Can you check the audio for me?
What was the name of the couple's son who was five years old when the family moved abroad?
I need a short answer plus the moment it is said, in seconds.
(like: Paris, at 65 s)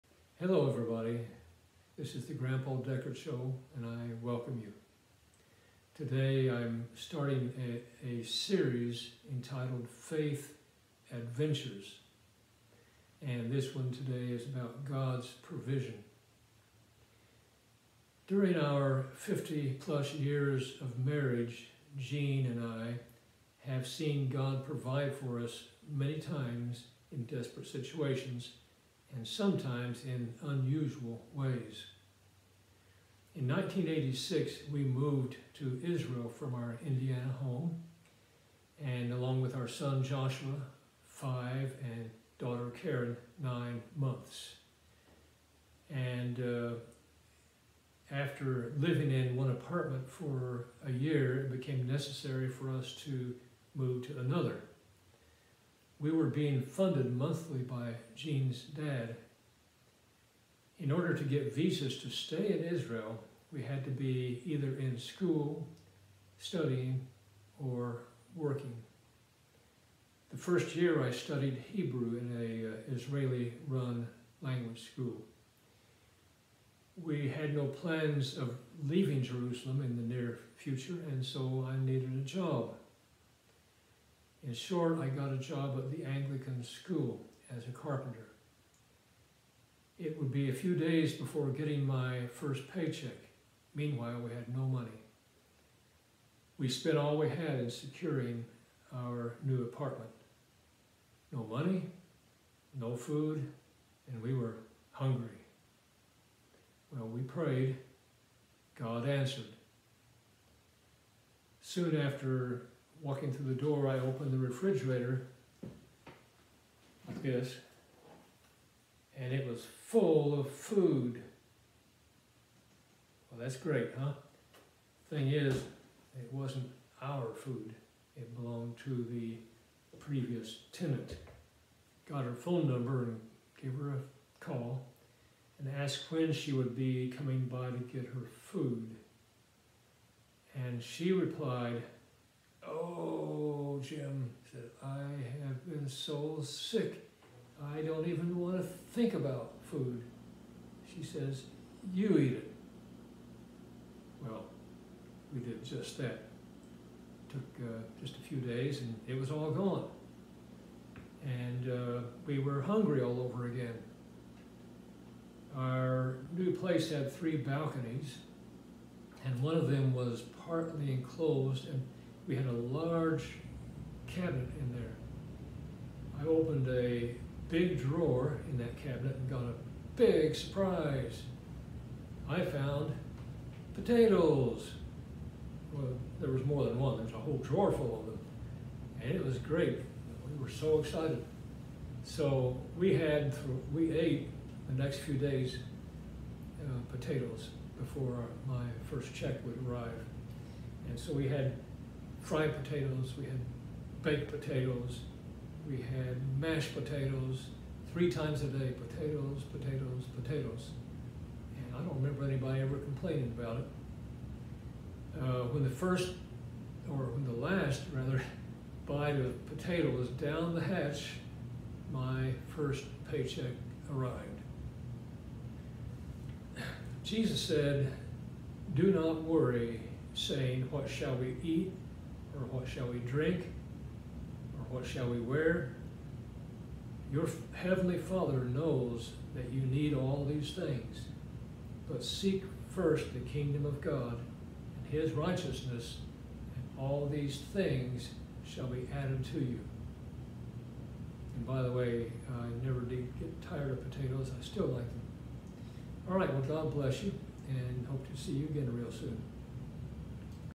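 Joshua, at 40 s.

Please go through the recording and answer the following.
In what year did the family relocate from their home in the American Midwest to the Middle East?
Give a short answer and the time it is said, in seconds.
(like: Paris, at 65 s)
1986, at 33 s.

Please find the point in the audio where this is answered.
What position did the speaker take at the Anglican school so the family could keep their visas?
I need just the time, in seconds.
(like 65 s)
87 s.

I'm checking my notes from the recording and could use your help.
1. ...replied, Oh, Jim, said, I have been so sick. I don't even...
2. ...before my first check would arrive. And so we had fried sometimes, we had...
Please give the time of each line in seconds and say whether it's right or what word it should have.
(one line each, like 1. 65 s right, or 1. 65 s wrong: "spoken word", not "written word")
1. 141 s right
2. 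197 s wrong: "potatoes", not "sometimes".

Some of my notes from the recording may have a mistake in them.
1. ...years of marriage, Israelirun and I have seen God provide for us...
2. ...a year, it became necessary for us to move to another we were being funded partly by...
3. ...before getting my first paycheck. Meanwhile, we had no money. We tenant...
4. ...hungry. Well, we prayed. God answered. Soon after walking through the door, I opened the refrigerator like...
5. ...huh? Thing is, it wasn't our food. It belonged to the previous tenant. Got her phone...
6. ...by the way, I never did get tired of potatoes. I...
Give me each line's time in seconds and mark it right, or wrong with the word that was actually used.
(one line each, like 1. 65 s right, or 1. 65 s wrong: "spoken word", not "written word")
1. 20 s wrong: "Jeanne", not "Israelirun"
2. 50 s wrong: "monthly", not "partly"
3. 91 s wrong: "spent", not "tenant"
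4. 104 s right
5. 123 s right
6. 251 s right.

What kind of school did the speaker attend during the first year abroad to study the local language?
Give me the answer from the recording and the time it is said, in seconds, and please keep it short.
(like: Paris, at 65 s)
Israeli-run language school, at 72 s.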